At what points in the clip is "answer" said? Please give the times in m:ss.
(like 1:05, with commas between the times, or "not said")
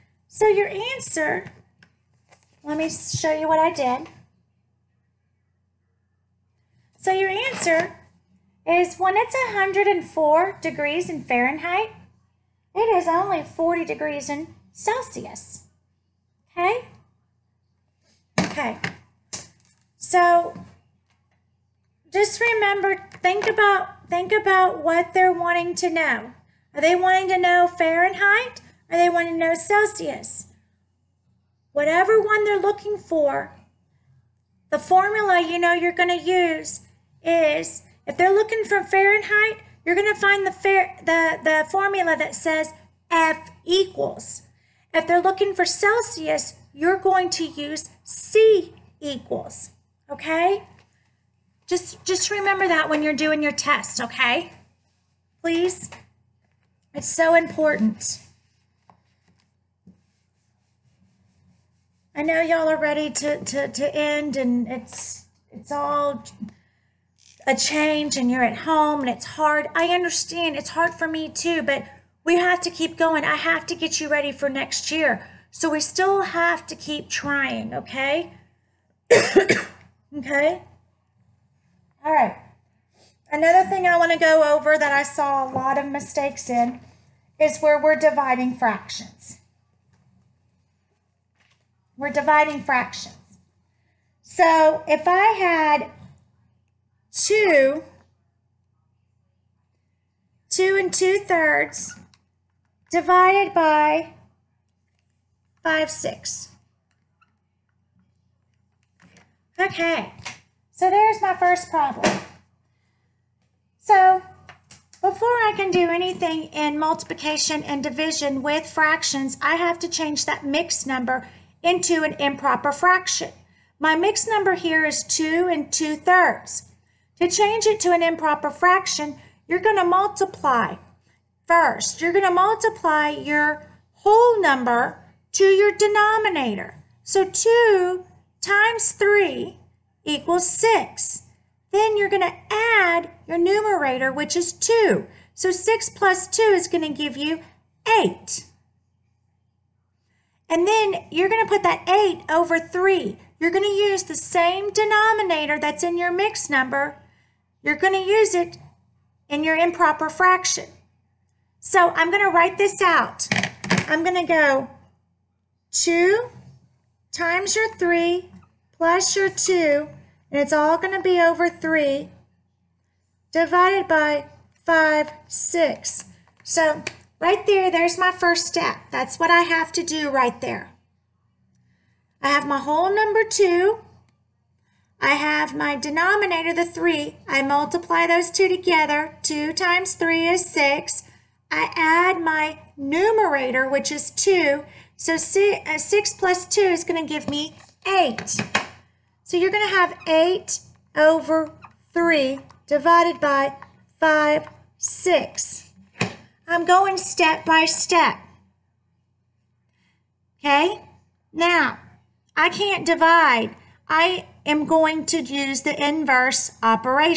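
0:00, 0:07.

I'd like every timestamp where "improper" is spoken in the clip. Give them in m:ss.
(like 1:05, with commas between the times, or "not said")
2:02, 2:08, 2:39.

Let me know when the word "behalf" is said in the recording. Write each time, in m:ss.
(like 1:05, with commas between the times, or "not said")
not said.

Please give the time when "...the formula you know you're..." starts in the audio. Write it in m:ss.
0:34.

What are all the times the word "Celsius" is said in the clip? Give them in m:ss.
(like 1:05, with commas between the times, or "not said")
0:14, 0:29, 0:45.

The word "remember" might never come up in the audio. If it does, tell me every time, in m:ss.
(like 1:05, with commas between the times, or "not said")
0:22, 0:52.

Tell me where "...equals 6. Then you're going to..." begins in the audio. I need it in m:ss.
2:20.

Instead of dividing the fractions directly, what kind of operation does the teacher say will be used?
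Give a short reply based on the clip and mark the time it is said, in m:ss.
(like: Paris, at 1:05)
inverse operation, at 3:35.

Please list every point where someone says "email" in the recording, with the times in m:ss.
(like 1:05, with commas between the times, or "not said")
not said.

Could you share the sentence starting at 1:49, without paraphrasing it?
Okay, so there's my first problem.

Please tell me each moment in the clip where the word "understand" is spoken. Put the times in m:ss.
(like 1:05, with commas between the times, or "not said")
1:09.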